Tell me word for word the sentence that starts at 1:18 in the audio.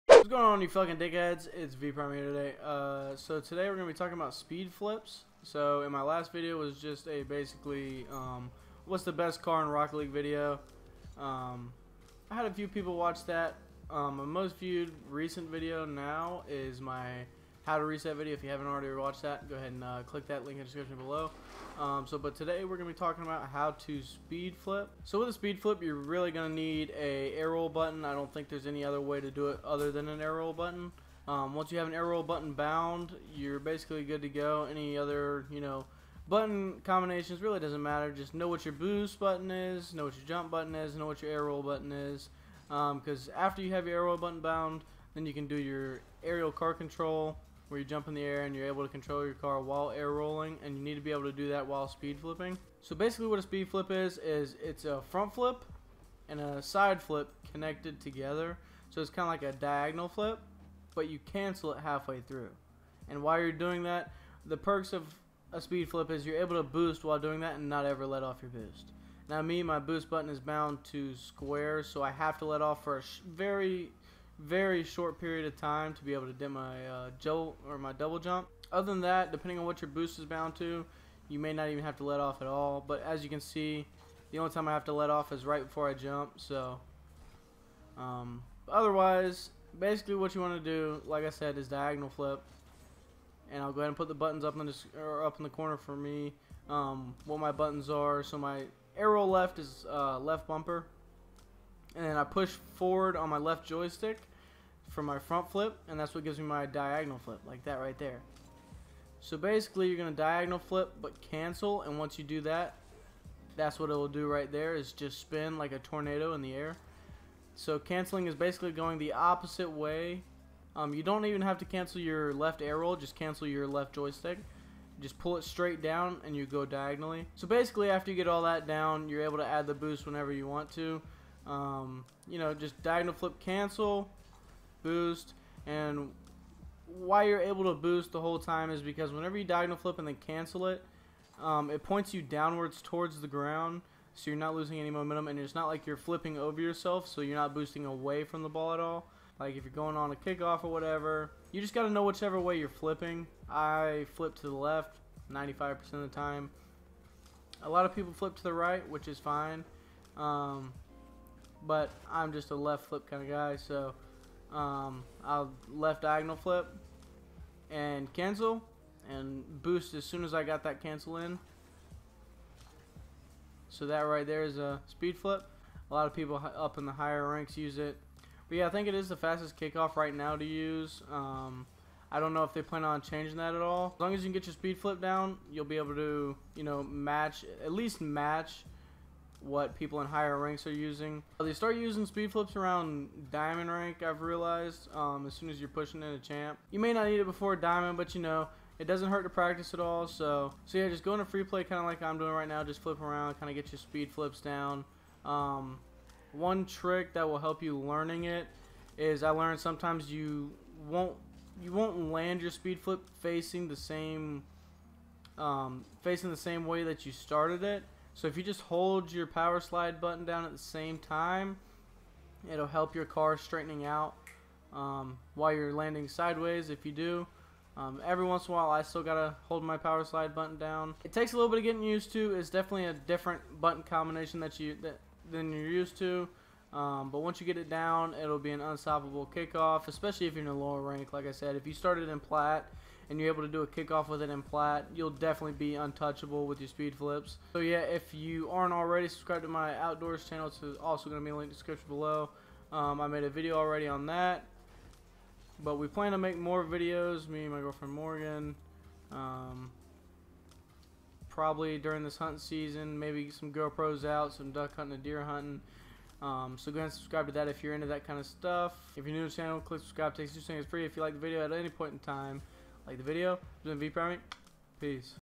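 Other than that, depending on what your boost is bound to, you may not even have to let off at all.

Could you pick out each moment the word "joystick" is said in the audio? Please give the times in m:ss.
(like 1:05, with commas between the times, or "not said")
1:43, 2:03.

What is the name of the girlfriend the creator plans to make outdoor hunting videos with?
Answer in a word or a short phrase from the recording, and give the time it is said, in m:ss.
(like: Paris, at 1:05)
Morgan, at 4:17.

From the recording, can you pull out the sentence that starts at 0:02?
Uh, so today we're gonna be talking about speed flips.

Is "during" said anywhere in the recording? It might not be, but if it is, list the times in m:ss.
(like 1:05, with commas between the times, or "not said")
4:21.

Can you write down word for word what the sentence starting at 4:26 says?
Um, so go ahead and subscribe to that if you're into that kind of stuff.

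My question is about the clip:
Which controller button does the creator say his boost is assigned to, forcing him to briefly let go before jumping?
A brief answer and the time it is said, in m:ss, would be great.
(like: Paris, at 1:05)
Square, at 1:11.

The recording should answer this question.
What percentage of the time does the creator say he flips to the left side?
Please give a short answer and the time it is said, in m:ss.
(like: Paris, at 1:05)
95%, at 2:35.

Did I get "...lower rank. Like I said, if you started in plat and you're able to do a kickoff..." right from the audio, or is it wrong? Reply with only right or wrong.
right.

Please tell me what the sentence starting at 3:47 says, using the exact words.
Um, every once in a while, I still gotta hold my power slide button down.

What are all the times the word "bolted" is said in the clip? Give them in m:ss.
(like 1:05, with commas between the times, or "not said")
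not said.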